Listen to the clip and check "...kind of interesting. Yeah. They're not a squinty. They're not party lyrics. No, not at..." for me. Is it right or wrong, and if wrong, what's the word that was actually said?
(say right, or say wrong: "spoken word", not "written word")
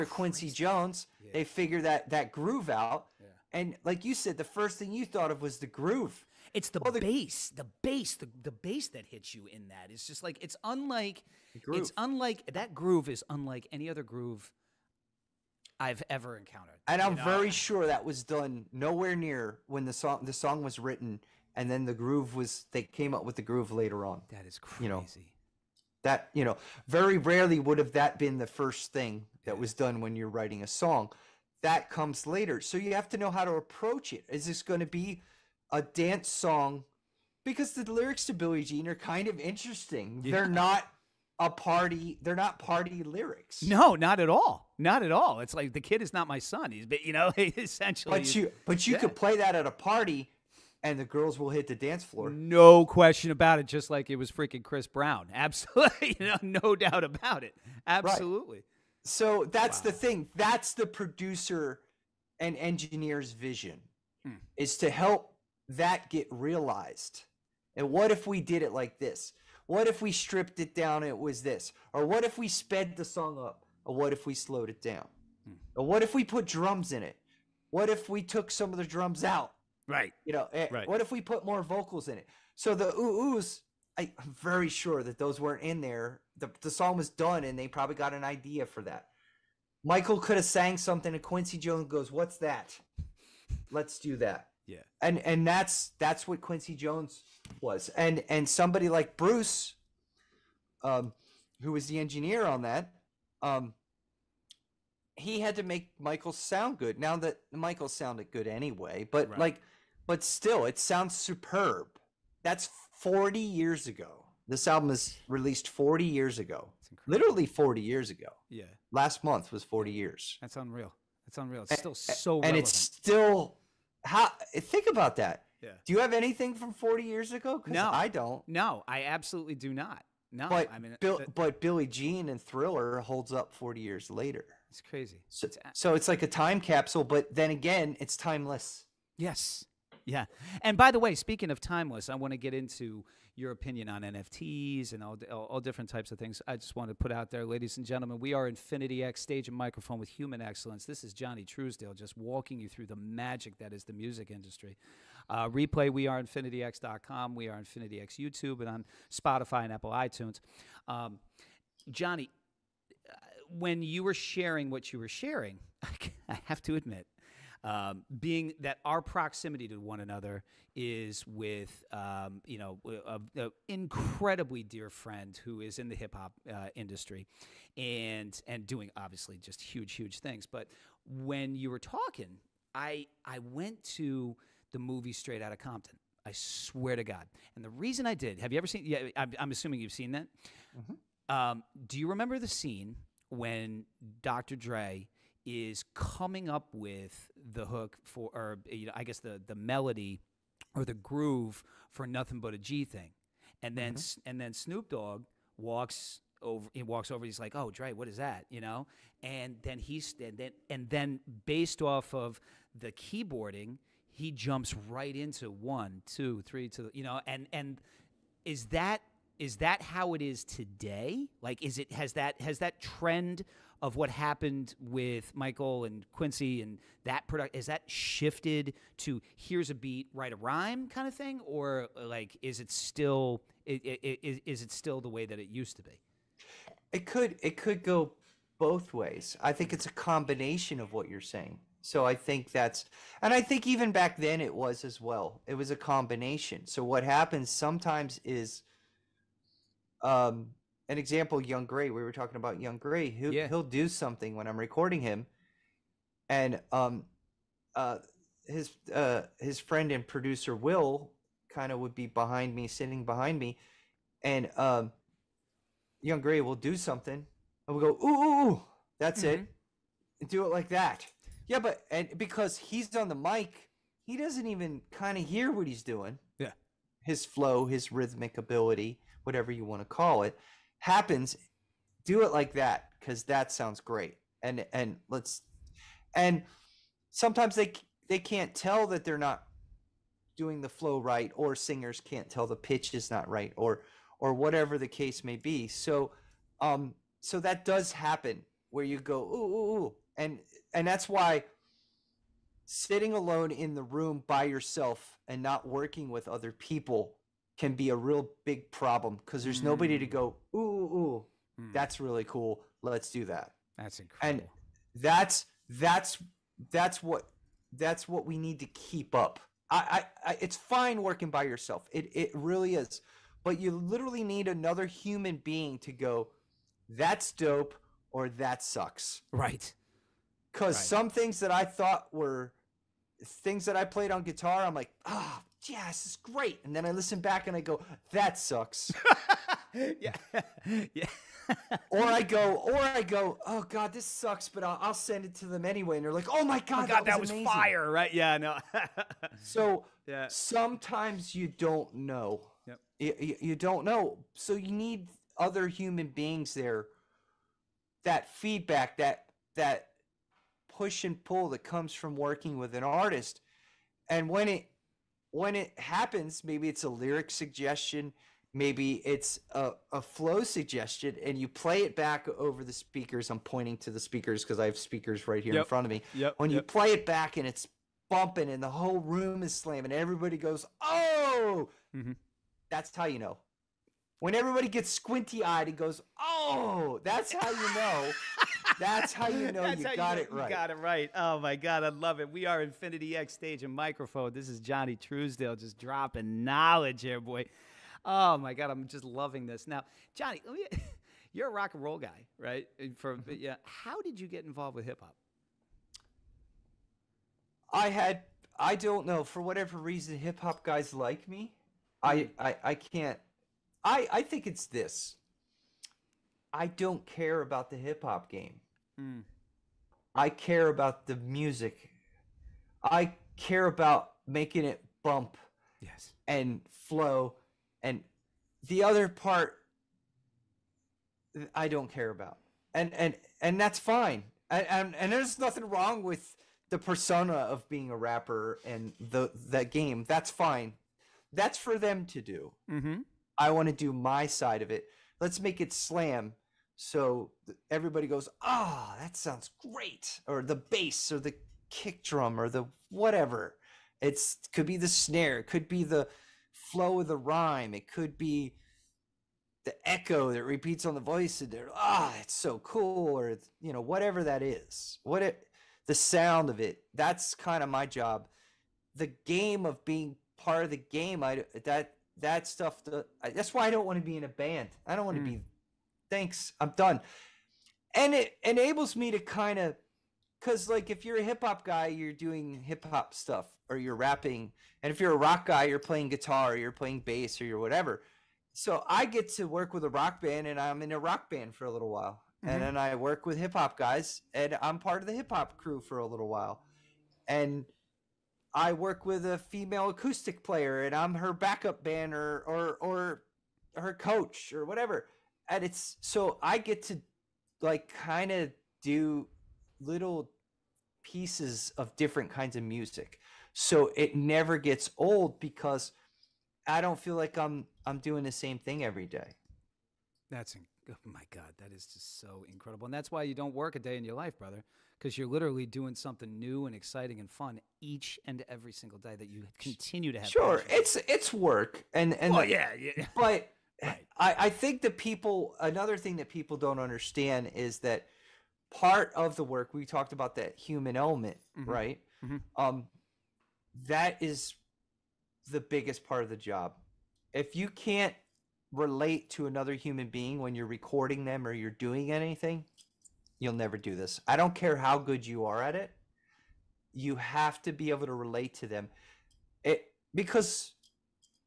wrong: "party", not "squinty".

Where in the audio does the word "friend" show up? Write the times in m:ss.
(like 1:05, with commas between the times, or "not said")
2:54, 4:19.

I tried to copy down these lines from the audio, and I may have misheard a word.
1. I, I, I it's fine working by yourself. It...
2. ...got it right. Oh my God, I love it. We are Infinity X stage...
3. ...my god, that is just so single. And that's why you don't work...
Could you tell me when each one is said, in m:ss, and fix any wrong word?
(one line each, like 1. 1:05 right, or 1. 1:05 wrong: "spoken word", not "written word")
1. 5:19 right
2. 6:30 right
3. 8:41 wrong: "incredible", not "single".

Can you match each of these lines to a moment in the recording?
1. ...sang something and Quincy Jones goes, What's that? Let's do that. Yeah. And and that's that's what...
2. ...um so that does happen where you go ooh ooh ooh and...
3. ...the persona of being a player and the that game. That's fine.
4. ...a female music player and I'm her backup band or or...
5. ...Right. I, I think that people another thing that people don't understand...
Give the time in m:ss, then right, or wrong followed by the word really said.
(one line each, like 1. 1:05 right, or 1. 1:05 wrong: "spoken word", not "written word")
1. 1:30 right
2. 4:56 right
3. 7:16 wrong: "rapper", not "player"
4. 8:19 wrong: "acoustic", not "music"
5. 8:53 right.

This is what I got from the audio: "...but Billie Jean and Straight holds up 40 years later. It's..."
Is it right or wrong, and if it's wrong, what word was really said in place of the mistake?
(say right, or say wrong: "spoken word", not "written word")
wrong: "Thriller", not "Straight".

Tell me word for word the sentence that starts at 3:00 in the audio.
But when you were talking, I I went to the movie Straight Outta Compton.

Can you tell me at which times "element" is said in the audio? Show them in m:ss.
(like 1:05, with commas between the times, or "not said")
9:00.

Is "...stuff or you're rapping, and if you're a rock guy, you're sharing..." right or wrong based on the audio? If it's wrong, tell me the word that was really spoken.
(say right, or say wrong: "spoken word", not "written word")
wrong: "playing", not "sharing".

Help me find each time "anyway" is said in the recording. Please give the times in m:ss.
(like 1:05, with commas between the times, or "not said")
1:48, 5:45.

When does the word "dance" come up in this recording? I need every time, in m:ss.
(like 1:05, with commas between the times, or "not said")
0:35, 0:51.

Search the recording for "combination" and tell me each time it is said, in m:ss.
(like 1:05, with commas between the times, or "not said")
3:59, 4:05.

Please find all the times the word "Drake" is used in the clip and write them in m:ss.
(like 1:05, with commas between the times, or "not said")
not said.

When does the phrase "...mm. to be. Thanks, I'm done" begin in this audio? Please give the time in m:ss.
7:55.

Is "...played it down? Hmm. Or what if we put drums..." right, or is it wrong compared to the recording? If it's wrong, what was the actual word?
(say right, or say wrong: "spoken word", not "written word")
wrong: "slowed", not "played".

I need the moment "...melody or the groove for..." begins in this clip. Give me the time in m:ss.
3:19.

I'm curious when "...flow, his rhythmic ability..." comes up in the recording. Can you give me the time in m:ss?
4:37.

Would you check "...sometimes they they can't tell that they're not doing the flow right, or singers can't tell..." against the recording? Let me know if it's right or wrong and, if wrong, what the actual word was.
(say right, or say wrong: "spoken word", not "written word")
right.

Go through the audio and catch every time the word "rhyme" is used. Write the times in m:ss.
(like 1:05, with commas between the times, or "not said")
3:50, 7:37.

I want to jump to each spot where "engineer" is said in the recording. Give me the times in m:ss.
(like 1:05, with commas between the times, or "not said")
1:02, 1:41.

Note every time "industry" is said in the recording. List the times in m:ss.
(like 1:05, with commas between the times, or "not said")
2:34, 2:56.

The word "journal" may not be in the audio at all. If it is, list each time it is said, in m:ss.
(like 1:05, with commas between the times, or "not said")
not said.